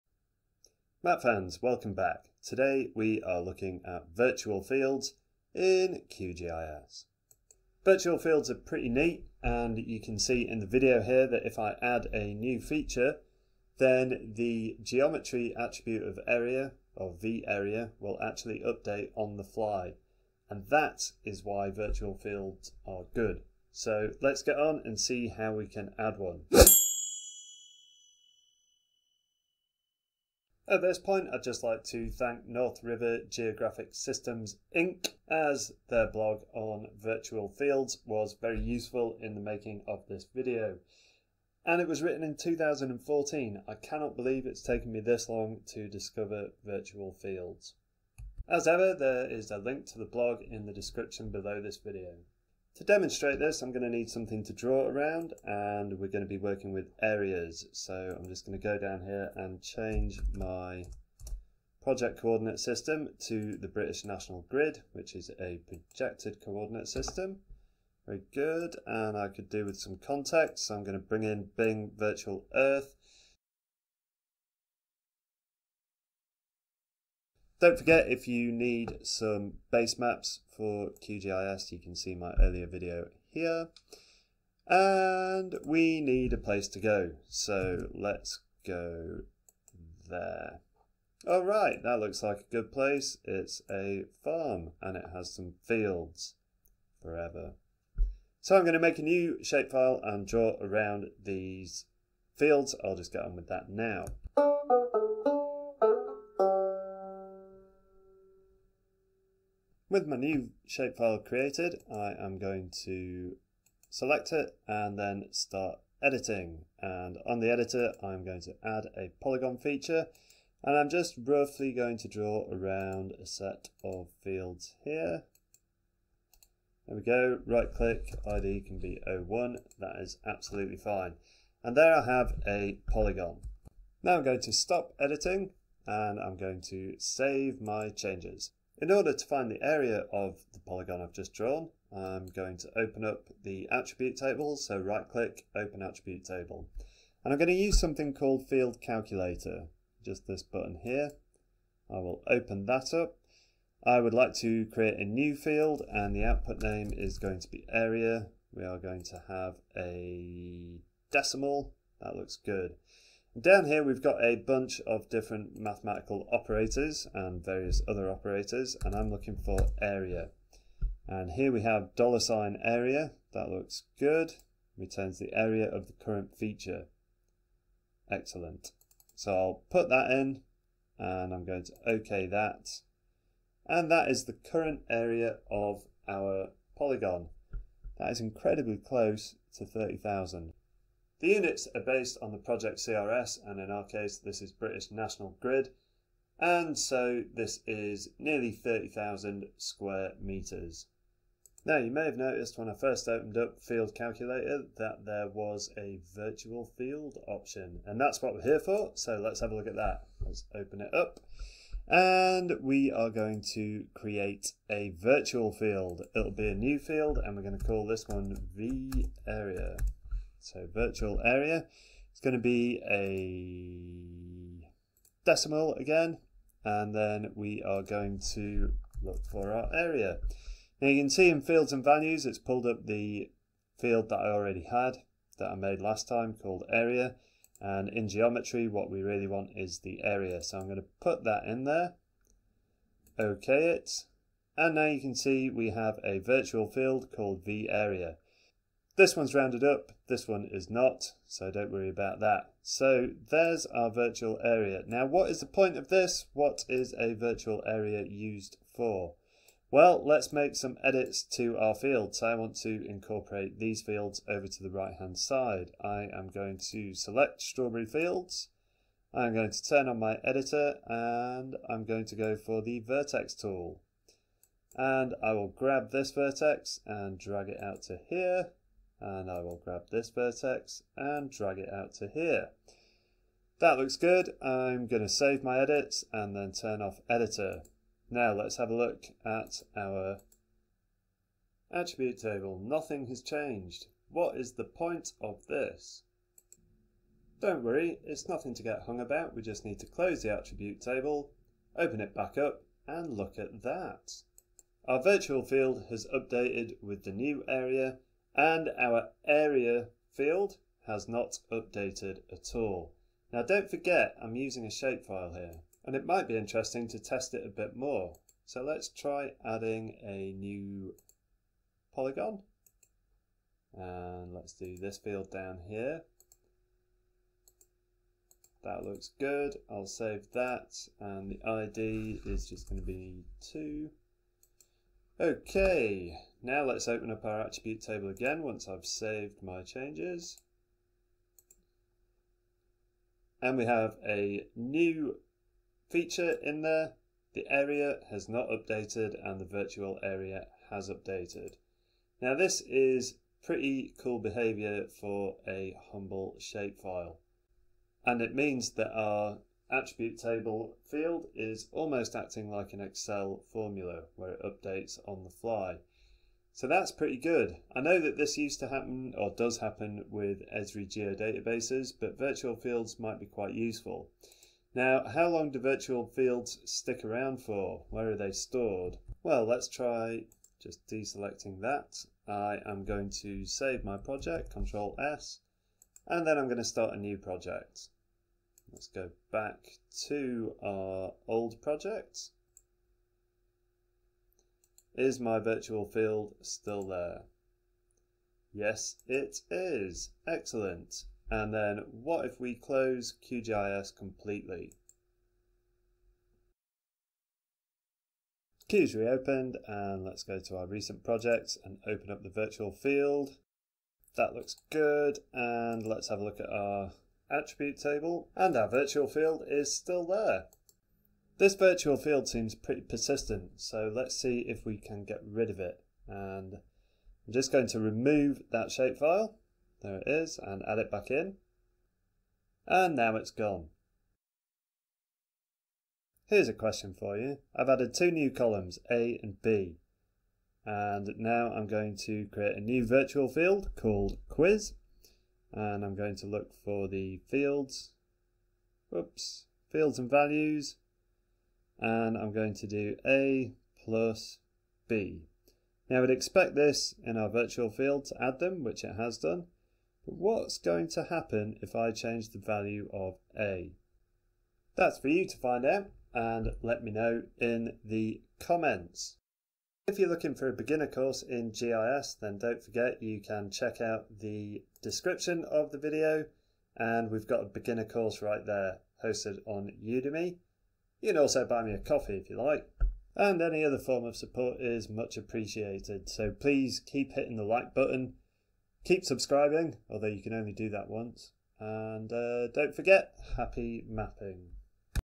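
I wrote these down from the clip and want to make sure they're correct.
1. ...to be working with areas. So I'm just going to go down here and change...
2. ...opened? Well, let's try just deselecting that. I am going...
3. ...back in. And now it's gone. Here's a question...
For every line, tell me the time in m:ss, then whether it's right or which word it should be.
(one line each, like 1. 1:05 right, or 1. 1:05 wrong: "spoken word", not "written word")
1. 0:56 right
2. 6:18 wrong: "stored", not "opened"
3. 7:10 right.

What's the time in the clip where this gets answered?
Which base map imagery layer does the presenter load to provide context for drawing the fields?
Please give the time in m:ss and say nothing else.
1:11.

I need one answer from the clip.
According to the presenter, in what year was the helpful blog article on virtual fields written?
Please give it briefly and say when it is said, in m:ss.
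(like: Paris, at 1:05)
2014, at 0:42.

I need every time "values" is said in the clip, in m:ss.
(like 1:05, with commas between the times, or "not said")
3:51, 7:30, 7:42.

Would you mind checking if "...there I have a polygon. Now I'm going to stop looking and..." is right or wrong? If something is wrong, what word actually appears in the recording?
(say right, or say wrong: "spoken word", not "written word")
wrong: "editing", not "looking".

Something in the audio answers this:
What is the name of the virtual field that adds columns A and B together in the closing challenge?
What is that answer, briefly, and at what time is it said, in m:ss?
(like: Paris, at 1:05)
quiz, at 7:24.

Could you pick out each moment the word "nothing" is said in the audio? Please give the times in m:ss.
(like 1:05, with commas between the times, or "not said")
4:52, 4:58.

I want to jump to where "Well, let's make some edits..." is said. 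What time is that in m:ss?
4:19.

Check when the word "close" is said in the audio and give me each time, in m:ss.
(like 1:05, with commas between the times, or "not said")
3:08, 4:59, 6:42.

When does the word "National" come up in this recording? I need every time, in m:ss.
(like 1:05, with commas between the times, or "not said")
1:04, 3:14.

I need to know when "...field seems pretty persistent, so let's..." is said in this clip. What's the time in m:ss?
7:01.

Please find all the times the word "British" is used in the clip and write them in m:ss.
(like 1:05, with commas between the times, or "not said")
1:03, 3:14.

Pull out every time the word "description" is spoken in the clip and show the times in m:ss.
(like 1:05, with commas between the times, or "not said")
0:50, 7:54.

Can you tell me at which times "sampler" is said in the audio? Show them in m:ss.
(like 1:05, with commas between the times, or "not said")
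not said.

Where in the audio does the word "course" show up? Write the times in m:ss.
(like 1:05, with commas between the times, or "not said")
7:50, 7:57.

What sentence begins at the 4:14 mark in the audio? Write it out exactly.
Now what is the point of this?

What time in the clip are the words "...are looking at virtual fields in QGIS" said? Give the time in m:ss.
0:03.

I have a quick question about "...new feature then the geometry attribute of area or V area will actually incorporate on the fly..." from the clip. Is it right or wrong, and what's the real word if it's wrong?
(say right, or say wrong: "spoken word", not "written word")
wrong: "update", not "incorporate".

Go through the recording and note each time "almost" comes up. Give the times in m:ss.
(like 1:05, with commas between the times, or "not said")
6:01.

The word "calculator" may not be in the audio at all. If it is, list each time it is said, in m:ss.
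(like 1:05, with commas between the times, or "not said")
2:28, 3:23.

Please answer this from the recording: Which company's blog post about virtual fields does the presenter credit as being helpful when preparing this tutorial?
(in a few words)
North River Geographic Systems Inc.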